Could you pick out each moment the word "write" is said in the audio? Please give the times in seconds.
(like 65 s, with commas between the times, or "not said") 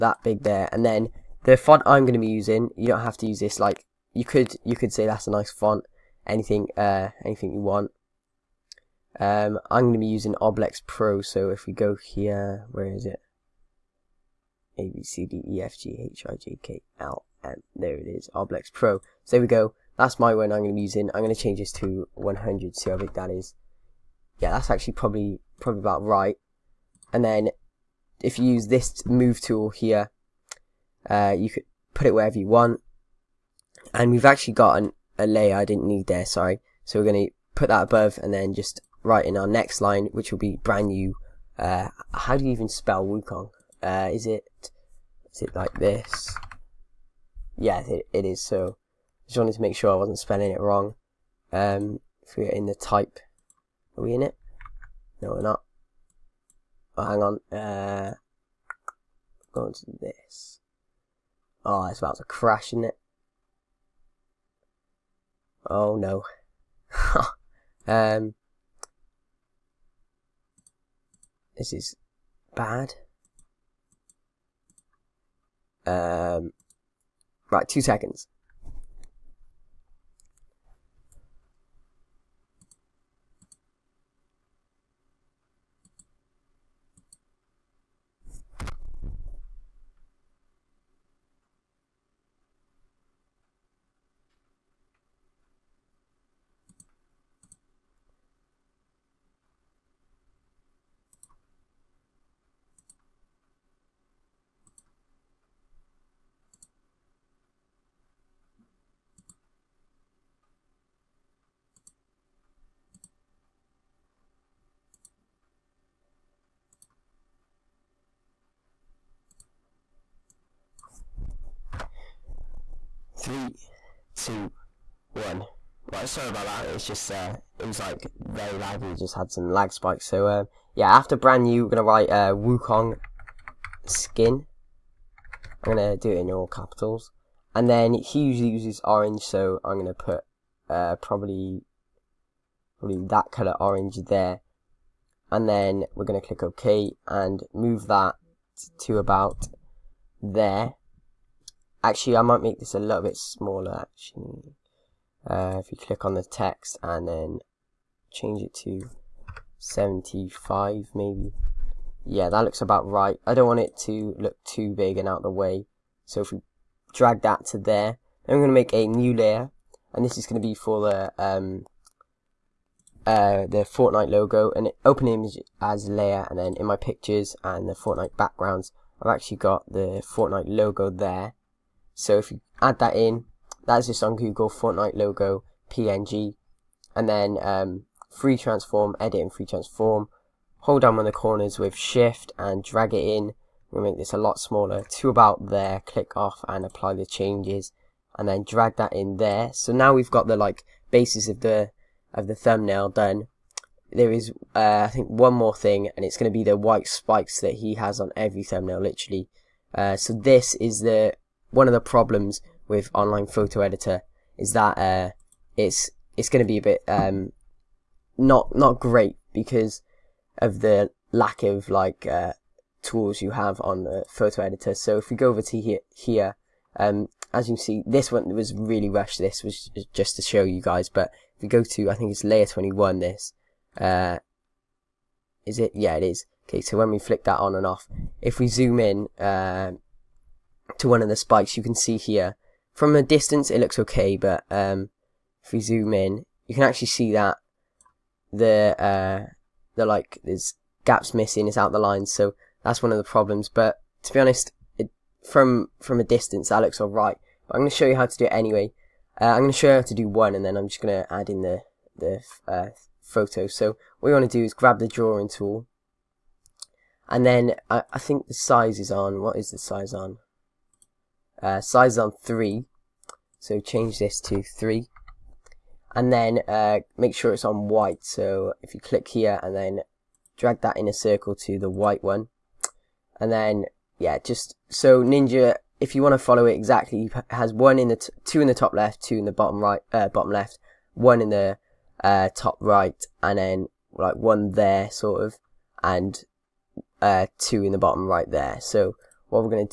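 39 s, 131 s.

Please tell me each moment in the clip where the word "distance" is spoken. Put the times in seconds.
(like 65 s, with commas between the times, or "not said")
243 s, 256 s.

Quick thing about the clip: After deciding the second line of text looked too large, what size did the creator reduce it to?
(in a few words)
75.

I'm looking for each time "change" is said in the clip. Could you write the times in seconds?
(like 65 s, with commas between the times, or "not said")
21 s, 158 s, 197 s, 273 s.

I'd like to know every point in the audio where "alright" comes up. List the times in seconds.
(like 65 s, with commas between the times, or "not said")
256 s.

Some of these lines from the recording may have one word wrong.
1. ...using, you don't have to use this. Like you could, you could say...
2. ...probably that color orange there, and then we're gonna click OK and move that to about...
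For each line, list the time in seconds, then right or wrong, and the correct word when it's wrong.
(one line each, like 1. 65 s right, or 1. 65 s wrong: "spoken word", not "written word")
1. 2 s right
2. 142 s right.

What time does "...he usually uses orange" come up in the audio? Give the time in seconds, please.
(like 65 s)
137 s.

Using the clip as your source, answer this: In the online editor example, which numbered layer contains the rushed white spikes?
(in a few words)
21.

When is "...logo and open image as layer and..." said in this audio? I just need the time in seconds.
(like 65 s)
174 s.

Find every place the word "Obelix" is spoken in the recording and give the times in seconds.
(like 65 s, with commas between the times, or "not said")
10 s, 18 s.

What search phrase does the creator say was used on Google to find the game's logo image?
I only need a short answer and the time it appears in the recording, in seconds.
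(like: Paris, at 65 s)
Fortnite logo PNG, at 184 s.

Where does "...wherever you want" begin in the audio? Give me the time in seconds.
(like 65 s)
32 s.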